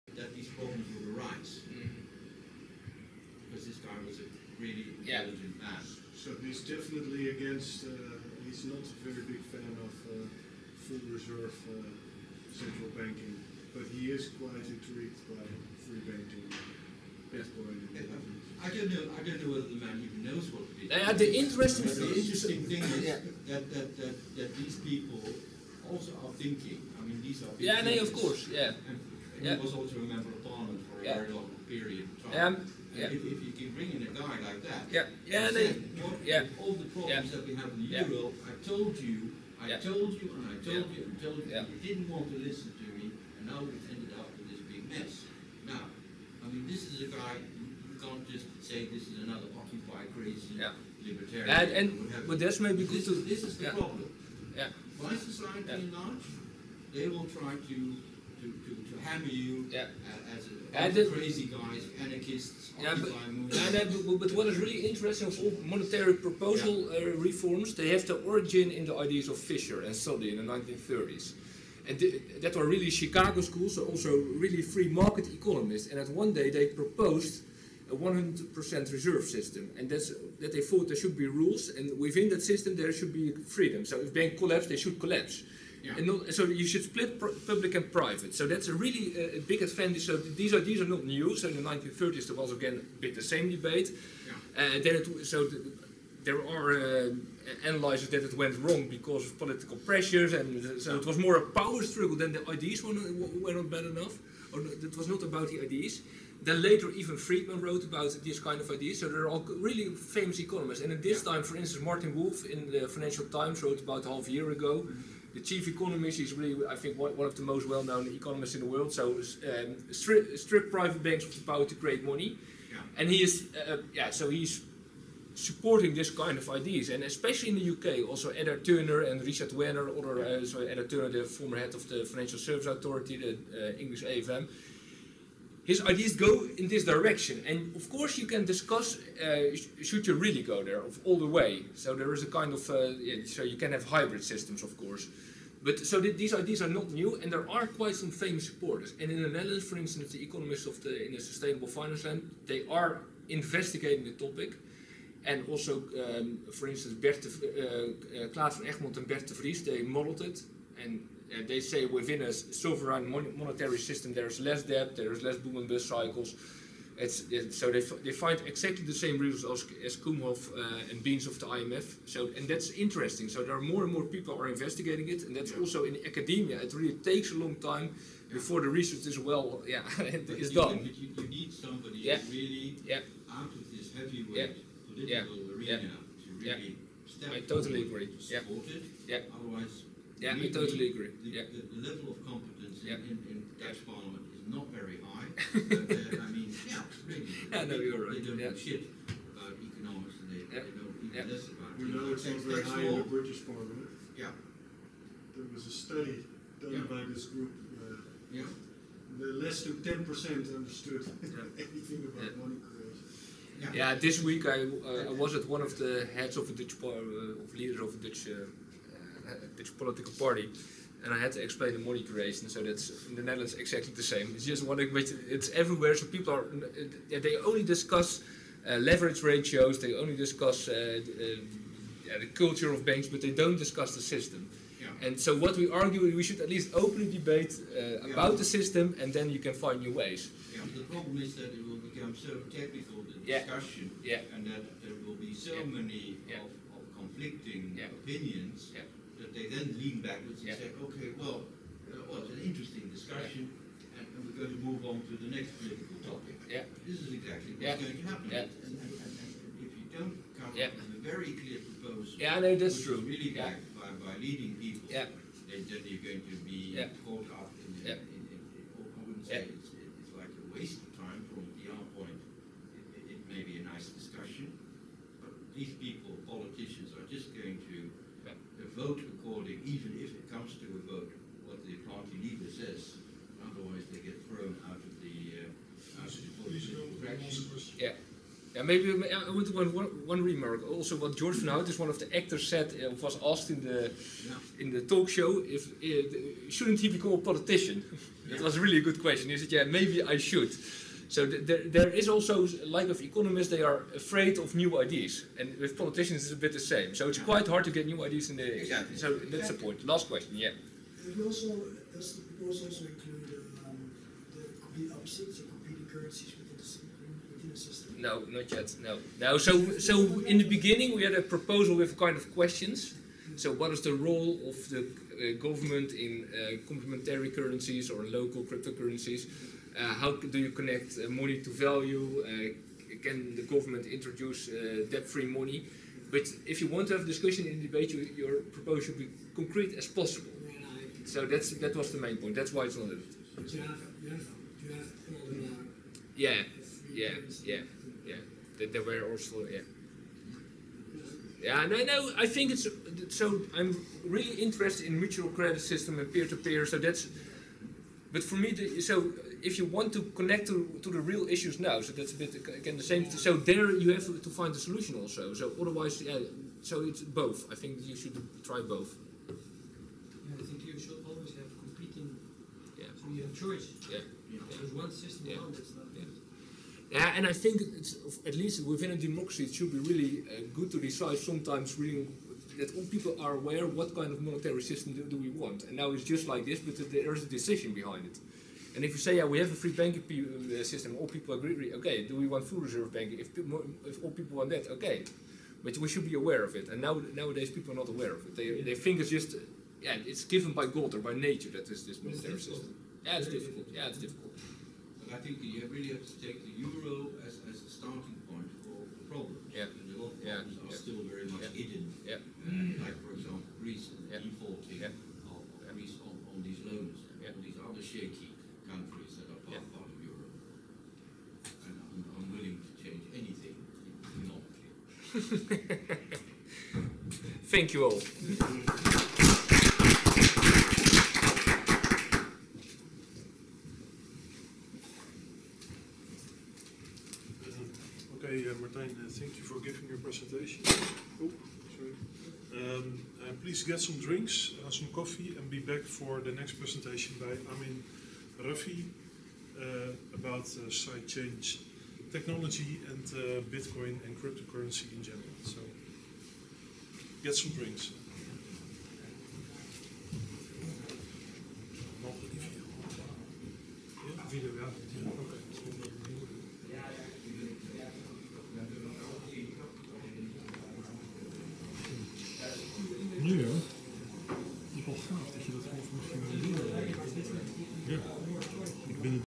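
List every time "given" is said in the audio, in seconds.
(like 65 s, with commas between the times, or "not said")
400 s.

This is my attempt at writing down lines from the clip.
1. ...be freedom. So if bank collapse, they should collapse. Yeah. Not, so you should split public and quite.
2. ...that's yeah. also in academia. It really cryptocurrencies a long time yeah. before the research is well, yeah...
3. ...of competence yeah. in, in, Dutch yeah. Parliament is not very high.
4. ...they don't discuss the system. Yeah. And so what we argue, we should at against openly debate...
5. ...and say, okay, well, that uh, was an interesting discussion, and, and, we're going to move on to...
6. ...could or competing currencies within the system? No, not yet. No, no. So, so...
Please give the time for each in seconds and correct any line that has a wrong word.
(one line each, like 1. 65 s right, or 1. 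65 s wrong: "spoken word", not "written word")
1. 83 s wrong: "private", not "quite"
2. 175 s wrong: "takes", not "cryptocurrencies"
3. 192 s right
4. 233 s wrong: "least", not "against"
5. 250 s right
6. 314 s right.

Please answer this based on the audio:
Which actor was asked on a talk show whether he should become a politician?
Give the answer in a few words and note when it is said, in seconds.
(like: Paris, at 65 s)
George van Houts, at 291 s.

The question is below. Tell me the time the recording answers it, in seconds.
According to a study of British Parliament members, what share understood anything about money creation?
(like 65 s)
209 s.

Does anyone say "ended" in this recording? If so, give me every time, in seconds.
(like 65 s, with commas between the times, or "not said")
43 s.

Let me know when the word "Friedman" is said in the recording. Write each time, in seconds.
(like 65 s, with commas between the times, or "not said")
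107 s.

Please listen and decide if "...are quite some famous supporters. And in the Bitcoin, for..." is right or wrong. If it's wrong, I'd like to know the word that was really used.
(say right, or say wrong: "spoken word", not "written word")
wrong: "Netherlands", not "Bitcoin".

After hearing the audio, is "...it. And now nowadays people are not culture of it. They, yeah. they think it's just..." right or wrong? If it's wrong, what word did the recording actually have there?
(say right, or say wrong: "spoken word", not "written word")
wrong: "aware", not "culture".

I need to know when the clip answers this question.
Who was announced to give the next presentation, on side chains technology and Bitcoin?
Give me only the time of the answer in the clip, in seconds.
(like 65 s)
447 s.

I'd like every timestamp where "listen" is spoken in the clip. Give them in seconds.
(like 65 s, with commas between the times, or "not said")
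42 s, 201 s.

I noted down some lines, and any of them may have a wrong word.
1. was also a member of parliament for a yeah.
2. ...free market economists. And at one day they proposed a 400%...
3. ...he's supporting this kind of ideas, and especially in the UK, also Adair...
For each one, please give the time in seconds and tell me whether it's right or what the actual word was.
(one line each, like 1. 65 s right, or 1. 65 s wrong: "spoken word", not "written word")
1. 29 s right
2. 74 s wrong: "100", not "400"
3. 124 s right.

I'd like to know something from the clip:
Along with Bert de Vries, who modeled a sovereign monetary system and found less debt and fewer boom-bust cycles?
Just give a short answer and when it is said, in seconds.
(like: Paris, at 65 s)
Klaas van Egmond, at 158 s.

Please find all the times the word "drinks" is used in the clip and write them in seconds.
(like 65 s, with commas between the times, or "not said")
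443 s, 457 s.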